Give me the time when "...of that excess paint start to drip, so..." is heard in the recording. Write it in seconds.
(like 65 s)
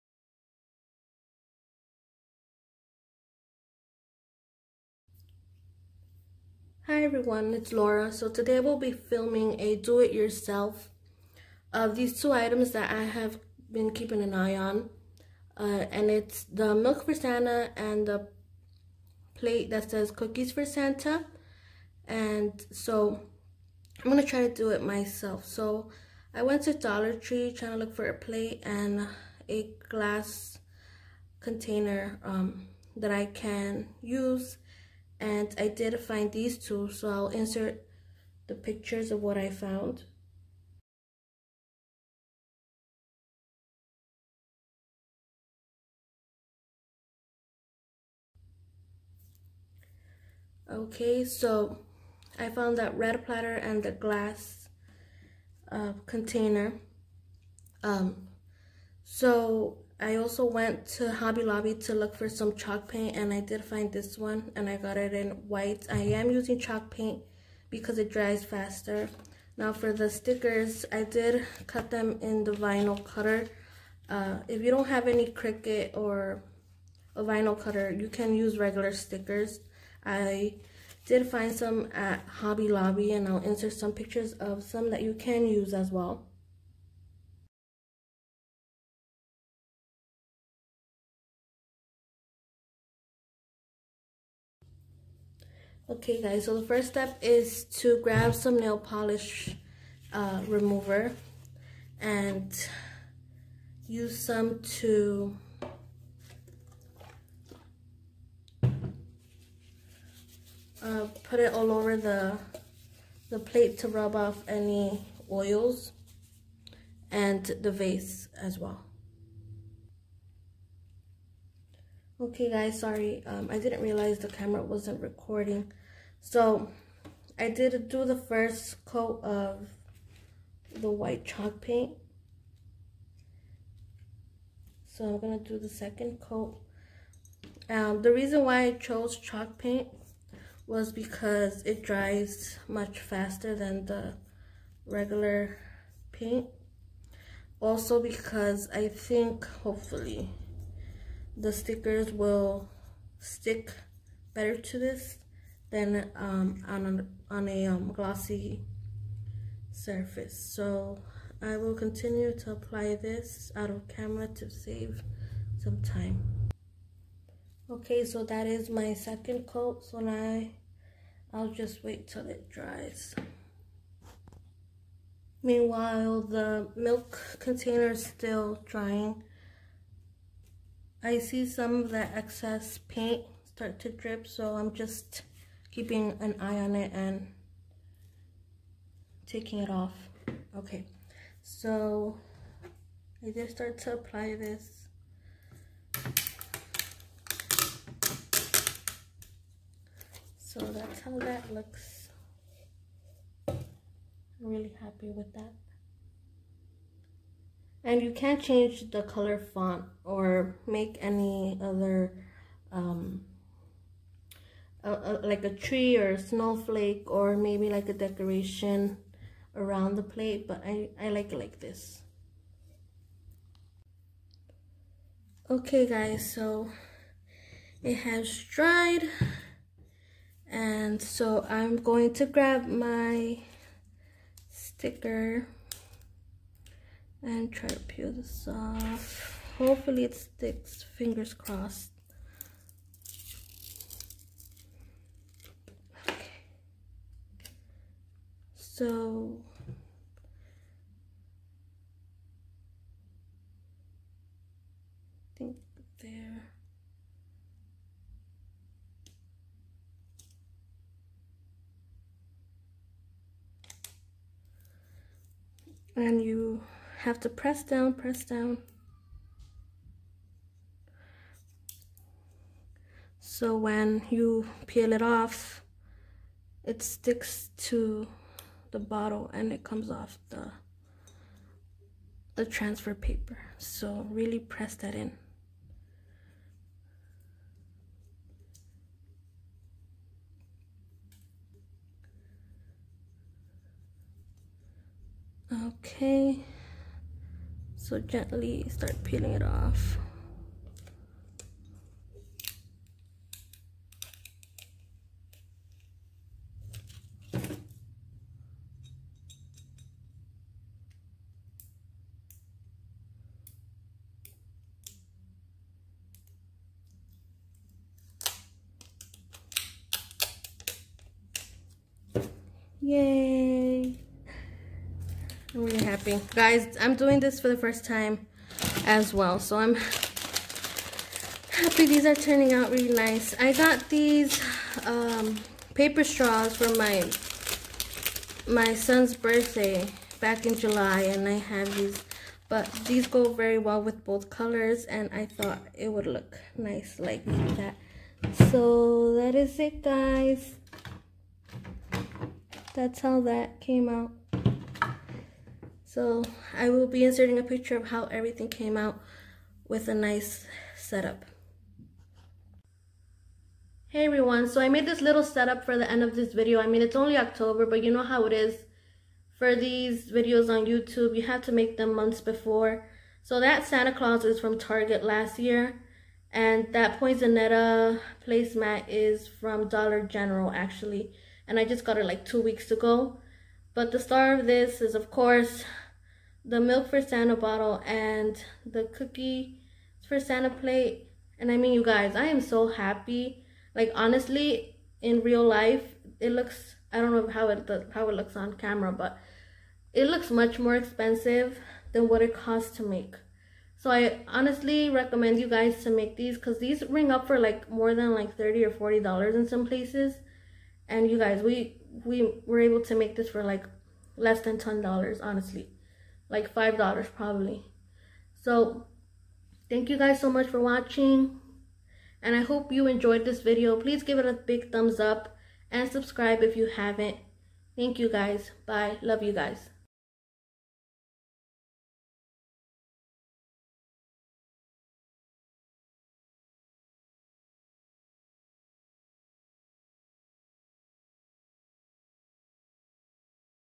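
181 s.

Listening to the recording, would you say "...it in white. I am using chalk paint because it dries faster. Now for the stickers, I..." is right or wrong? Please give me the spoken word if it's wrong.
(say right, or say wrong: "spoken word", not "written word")
right.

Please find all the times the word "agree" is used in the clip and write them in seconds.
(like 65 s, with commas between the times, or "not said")
not said.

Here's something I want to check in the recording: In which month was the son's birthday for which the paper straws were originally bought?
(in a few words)
July.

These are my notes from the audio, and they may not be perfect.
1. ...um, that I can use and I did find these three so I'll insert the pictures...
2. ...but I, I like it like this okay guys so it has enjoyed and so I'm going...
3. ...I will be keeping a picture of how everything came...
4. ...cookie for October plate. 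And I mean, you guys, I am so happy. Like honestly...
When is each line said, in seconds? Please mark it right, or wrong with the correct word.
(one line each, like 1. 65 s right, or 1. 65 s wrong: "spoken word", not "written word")
1. 32 s wrong: "two", not "three"
2. 220 s wrong: "dried", not "enjoyed"
3. 356 s wrong: "inserting", not "keeping"
4. 388 s wrong: "Santa", not "October".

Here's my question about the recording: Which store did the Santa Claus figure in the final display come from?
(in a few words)
Target.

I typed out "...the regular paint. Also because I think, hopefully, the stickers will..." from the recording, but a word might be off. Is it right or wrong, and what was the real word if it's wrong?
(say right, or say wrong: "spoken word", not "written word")
right.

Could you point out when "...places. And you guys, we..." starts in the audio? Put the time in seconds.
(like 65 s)
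409 s.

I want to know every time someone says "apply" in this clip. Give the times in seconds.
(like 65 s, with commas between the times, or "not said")
162 s, 193 s.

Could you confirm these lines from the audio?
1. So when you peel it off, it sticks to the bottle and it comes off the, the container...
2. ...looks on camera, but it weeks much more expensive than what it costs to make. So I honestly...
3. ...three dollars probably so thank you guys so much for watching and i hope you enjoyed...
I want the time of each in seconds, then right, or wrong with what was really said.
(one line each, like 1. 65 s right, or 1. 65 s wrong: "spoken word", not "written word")
1. 273 s wrong: "transfer", not "container"
2. 398 s wrong: "looks", not "weeks"
3. 416 s wrong: "five", not "three".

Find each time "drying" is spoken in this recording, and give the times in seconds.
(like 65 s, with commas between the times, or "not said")
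178 s.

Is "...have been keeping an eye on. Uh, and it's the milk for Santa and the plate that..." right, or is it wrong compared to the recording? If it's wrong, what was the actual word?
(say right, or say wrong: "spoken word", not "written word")
right.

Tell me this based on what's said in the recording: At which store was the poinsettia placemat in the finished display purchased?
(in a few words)
Dollar General.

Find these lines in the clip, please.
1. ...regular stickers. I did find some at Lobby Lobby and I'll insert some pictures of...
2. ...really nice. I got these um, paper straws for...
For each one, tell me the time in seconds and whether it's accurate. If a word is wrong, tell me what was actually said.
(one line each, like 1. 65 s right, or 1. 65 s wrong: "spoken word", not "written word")
1. 78 s wrong: "Hobby", not "Lobby"
2. 332 s right.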